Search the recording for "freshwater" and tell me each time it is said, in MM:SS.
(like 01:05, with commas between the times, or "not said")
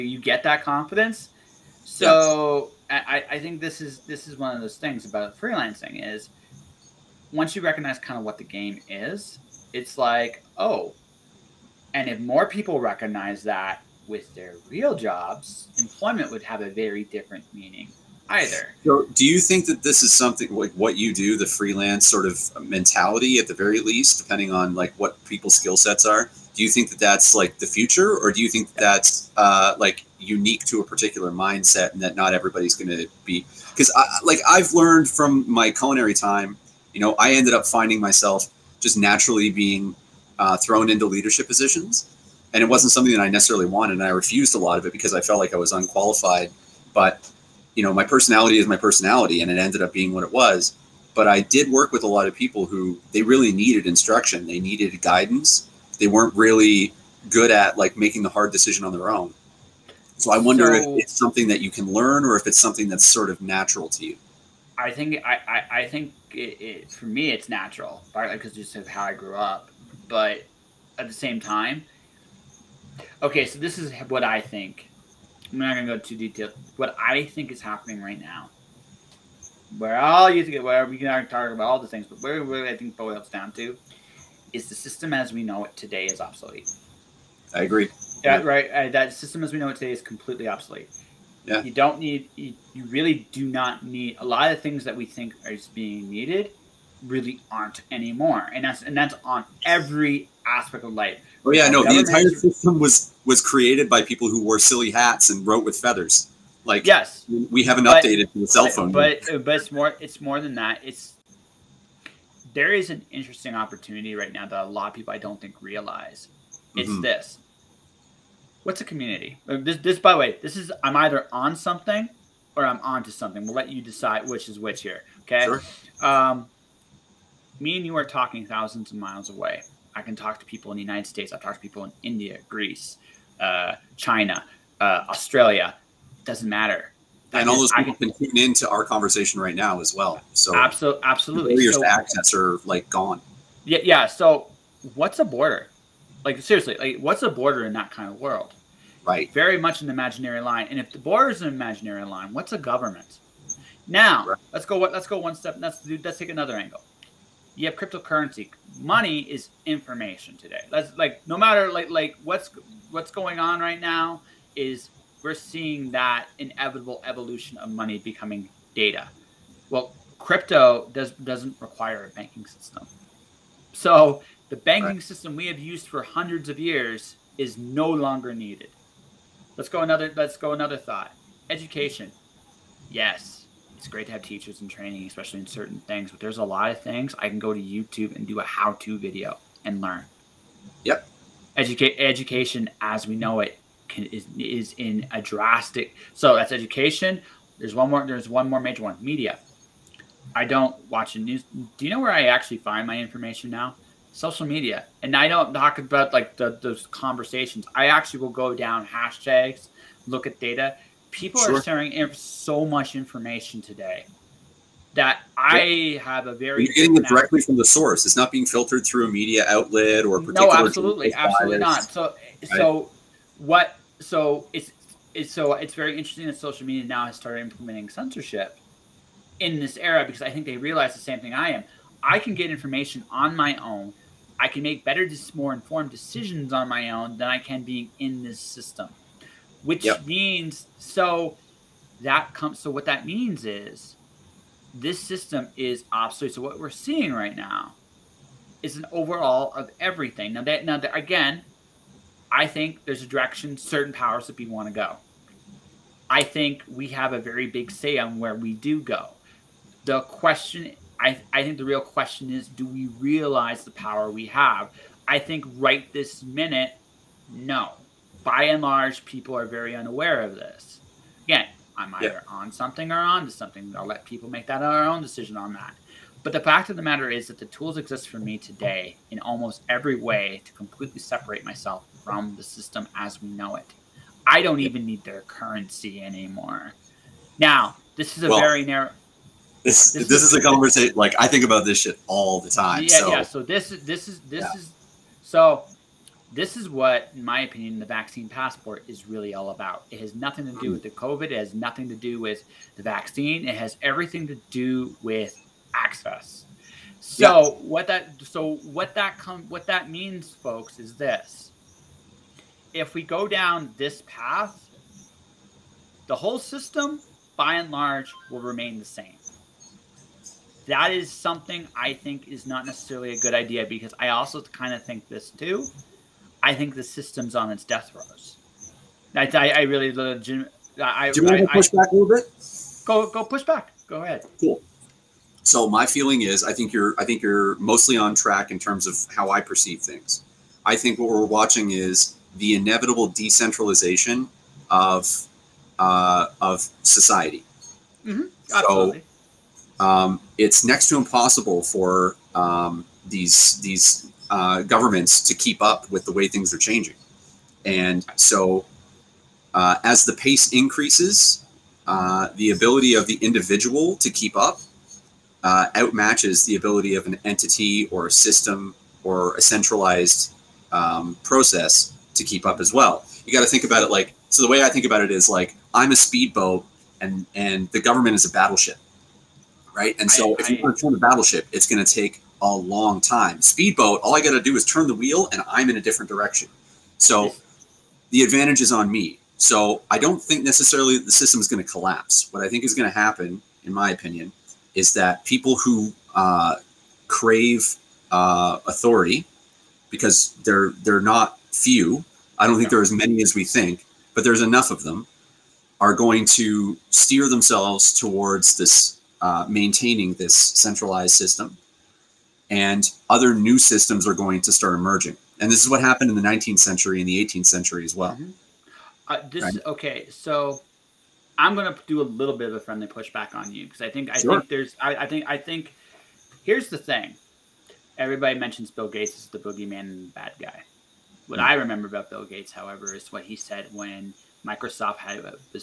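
not said.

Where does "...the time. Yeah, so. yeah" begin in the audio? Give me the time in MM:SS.
04:52.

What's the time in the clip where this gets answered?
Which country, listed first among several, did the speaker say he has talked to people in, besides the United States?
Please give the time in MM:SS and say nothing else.
02:12.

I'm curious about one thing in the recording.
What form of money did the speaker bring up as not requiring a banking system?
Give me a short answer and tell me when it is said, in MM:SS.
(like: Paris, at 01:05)
cryptocurrency, at 02:37.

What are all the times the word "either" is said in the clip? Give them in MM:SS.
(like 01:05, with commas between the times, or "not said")
00:18, 02:01, 04:31.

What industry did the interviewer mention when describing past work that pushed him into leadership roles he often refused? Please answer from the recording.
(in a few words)
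culinary.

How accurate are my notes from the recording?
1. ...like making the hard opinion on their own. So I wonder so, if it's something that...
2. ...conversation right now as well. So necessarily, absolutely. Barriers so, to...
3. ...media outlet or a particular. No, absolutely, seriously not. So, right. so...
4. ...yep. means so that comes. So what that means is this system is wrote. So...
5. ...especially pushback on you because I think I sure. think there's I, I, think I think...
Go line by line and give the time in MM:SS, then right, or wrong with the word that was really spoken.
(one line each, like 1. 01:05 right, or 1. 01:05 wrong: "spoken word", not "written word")
1. 00:57 wrong: "decision", not "opinion"
2. 02:18 wrong: "absolutely", not "necessarily"
3. 03:39 wrong: "absolutely", not "seriously"
4. 03:59 wrong: "obsolete", not "wrote"
5. 07:02 wrong: "friendly", not "especially".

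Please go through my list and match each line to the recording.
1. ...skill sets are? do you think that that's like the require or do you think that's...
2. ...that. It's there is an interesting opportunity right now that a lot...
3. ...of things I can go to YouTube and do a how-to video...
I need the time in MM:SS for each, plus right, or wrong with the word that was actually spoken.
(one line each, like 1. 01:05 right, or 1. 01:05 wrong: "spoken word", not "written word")
1. 00:25 wrong: "future", not "require"
2. 01:50 right
3. 03:06 right.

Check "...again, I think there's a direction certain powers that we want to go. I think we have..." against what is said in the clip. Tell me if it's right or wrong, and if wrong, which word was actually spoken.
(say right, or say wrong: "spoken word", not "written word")
right.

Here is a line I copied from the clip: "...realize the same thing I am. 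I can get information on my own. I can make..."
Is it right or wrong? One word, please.
right.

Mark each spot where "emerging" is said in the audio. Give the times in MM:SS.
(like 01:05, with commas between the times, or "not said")
06:54.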